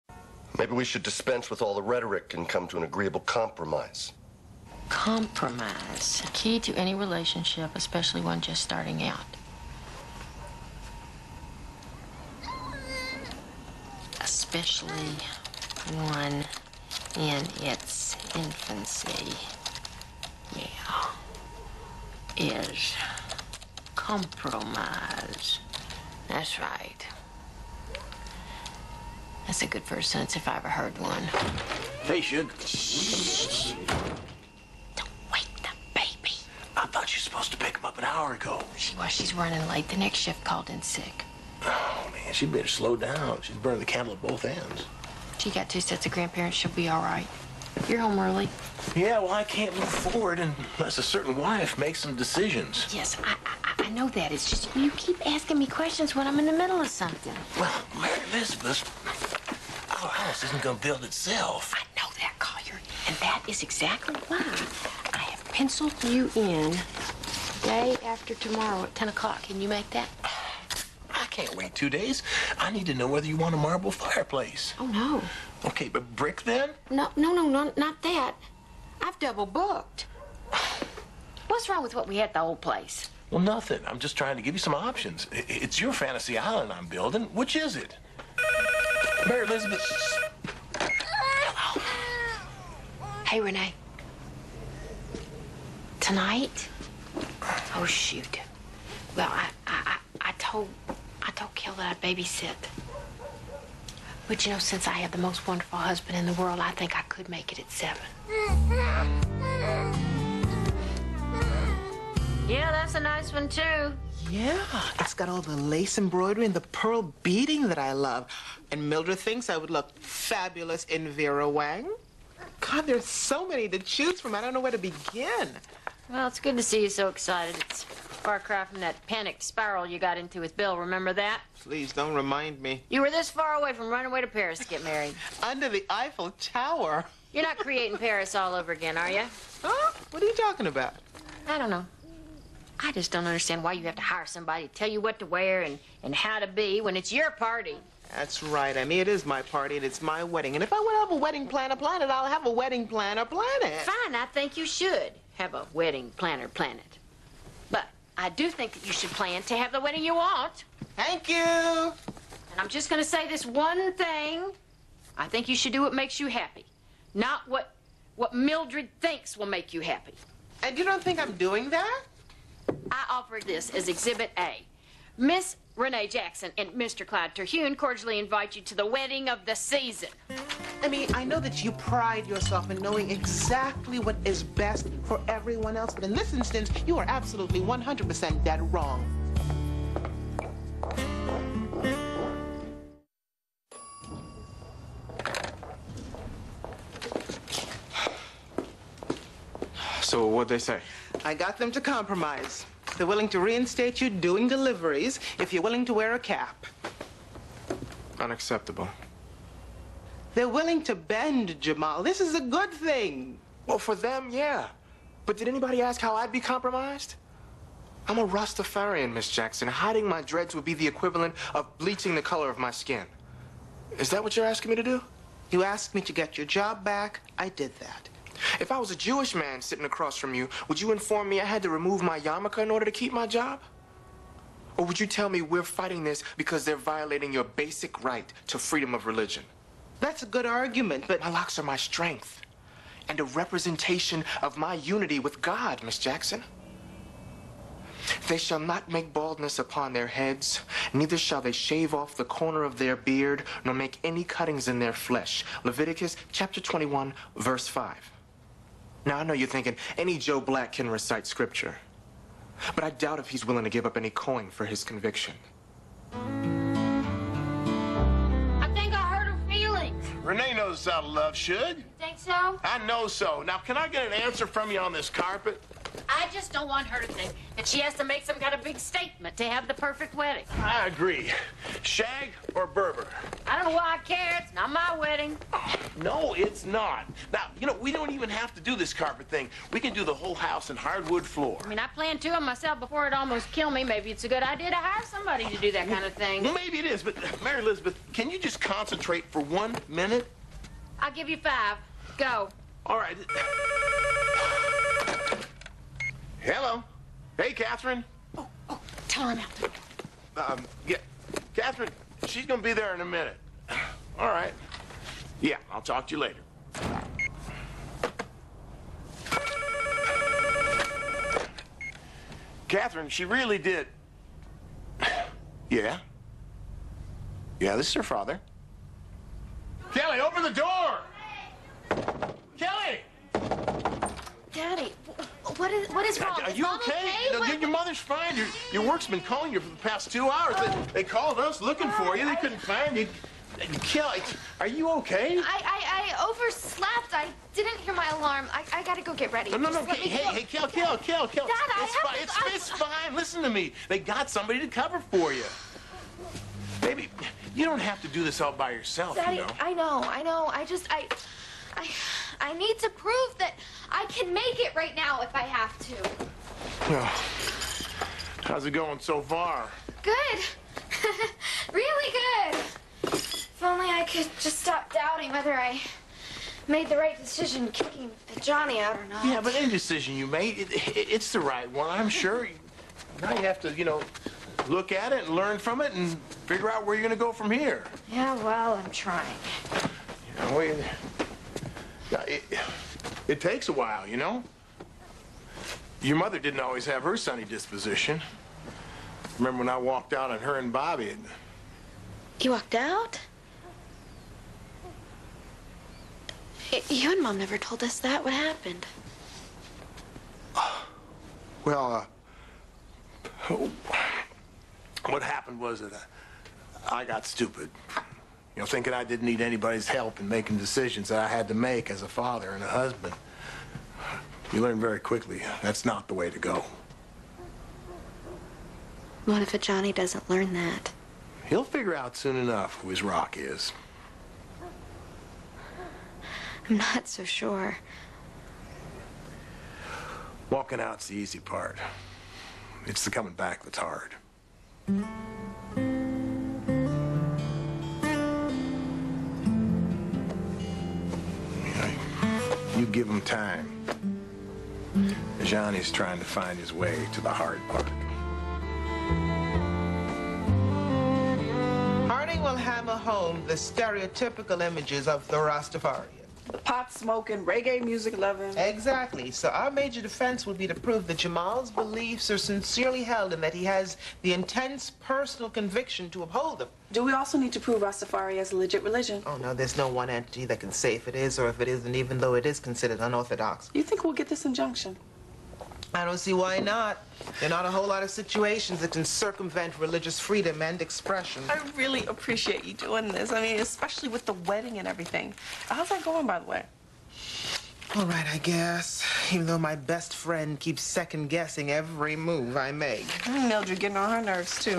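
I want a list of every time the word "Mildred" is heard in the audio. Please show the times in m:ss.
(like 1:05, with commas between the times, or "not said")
1:58, 2:48, 8:23.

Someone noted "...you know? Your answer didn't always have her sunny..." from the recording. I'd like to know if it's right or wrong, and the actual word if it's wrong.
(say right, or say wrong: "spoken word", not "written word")
wrong: "mother", not "answer".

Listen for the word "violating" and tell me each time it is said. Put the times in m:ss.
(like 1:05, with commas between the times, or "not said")
3:56.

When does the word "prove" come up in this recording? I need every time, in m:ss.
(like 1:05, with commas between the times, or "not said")
6:02, 7:50, 7:57.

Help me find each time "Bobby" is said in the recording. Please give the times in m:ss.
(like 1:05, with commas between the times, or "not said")
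6:40.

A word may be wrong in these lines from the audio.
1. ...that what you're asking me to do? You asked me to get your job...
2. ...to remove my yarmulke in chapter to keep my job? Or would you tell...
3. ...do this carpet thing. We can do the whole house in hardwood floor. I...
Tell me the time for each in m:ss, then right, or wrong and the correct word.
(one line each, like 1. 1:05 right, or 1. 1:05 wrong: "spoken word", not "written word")
1. 3:44 right
2. 3:51 wrong: "order", not "chapter"
3. 4:48 right.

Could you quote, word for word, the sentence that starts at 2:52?
I offer this as Exhibit A.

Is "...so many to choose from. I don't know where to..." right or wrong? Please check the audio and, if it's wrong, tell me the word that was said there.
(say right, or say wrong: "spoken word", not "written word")
right.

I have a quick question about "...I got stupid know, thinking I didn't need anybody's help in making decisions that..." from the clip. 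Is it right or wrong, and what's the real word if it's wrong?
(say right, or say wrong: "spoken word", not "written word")
right.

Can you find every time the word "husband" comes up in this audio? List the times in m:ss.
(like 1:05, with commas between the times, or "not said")
1:45, 7:02.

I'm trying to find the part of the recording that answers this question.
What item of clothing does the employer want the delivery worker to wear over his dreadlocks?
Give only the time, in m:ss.
3:26.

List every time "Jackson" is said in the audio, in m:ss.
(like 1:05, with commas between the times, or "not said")
2:56, 3:39, 4:05.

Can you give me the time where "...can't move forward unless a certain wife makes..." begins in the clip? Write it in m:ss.
0:49.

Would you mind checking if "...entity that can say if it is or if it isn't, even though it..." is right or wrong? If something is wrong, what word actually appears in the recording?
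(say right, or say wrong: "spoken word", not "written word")
right.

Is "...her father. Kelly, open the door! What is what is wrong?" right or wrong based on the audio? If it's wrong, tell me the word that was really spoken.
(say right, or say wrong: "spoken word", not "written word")
right.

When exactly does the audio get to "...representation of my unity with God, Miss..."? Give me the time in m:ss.
4:03.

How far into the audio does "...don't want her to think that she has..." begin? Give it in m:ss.
4:36.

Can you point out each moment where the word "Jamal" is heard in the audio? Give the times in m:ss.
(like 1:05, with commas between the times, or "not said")
3:31, 7:51.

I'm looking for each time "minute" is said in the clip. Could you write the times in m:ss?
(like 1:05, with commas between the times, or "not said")
4:59, 5:13.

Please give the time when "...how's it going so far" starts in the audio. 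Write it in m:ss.
6:08.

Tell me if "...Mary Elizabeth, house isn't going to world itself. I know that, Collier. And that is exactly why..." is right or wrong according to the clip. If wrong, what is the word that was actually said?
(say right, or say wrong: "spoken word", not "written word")
wrong: "build", not "world".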